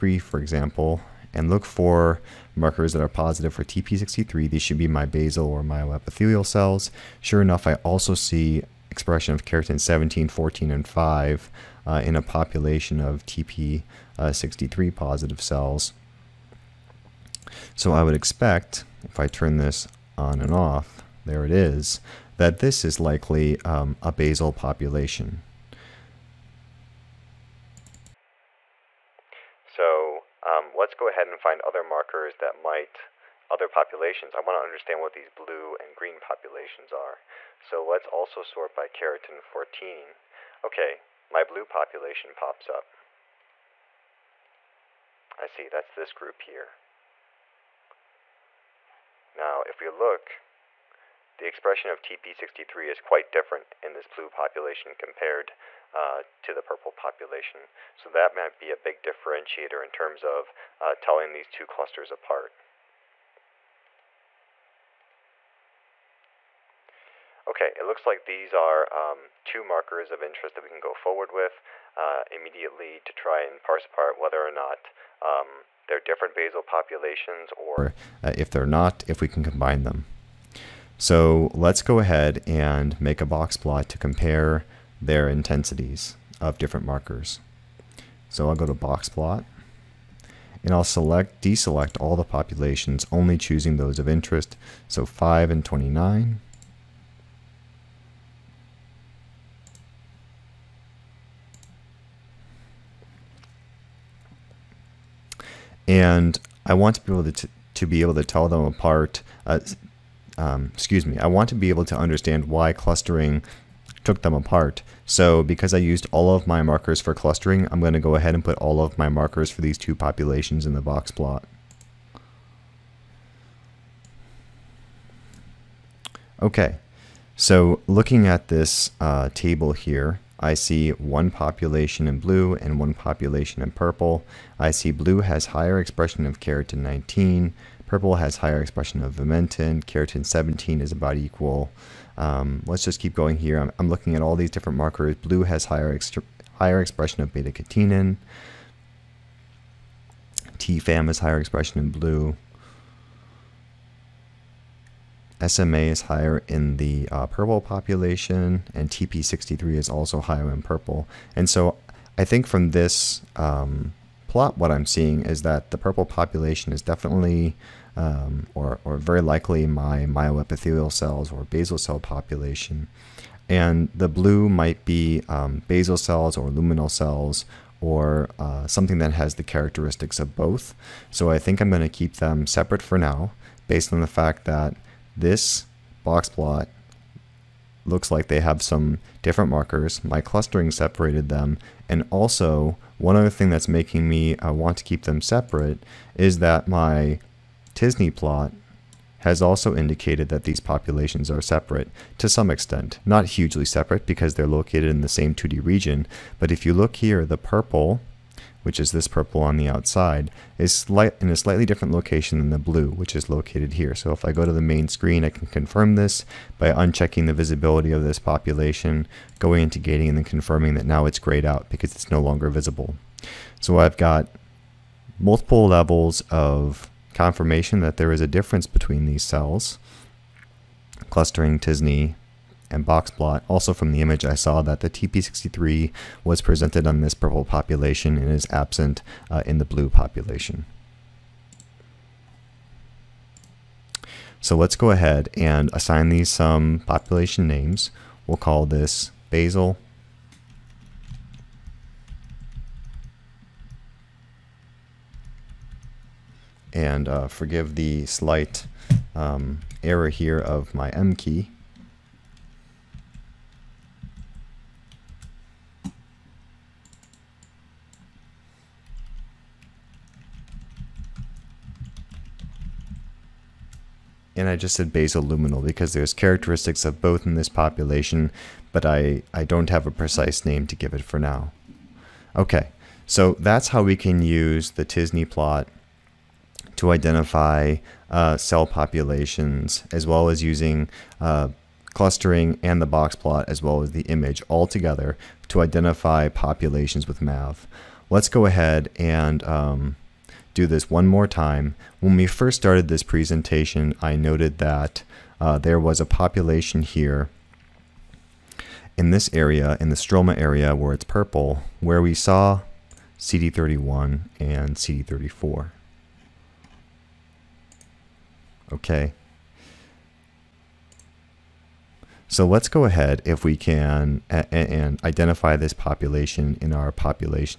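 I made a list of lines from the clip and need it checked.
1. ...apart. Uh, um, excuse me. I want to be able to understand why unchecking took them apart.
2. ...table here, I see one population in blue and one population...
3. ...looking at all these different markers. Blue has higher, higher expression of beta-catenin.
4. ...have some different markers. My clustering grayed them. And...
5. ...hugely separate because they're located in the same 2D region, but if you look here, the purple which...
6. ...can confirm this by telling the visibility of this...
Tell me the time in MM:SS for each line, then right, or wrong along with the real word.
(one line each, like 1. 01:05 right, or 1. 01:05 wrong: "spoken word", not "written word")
1. 01:48 wrong: "clustering", not "unchecking"
2. 02:09 right
3. 02:23 right
4. 03:08 wrong: "separated", not "grayed"
5. 03:23 right
6. 03:35 wrong: "unchecking", not "telling".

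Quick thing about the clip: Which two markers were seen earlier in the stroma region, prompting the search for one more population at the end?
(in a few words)
CD31 and CD34.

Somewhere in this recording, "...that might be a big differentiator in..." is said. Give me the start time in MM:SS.
00:58.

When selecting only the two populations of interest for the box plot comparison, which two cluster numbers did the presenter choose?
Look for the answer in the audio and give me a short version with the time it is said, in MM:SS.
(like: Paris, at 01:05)
5 and 29, at 01:35.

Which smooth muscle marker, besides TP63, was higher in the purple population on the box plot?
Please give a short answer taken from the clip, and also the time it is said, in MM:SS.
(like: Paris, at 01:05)
SMA, at 02:35.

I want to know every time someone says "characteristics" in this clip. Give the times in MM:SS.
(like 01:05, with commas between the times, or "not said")
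02:59, 04:36.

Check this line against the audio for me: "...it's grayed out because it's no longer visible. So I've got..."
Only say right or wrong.
right.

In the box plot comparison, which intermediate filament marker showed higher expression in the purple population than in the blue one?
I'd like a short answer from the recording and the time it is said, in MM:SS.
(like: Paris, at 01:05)
vimentin, at 02:19.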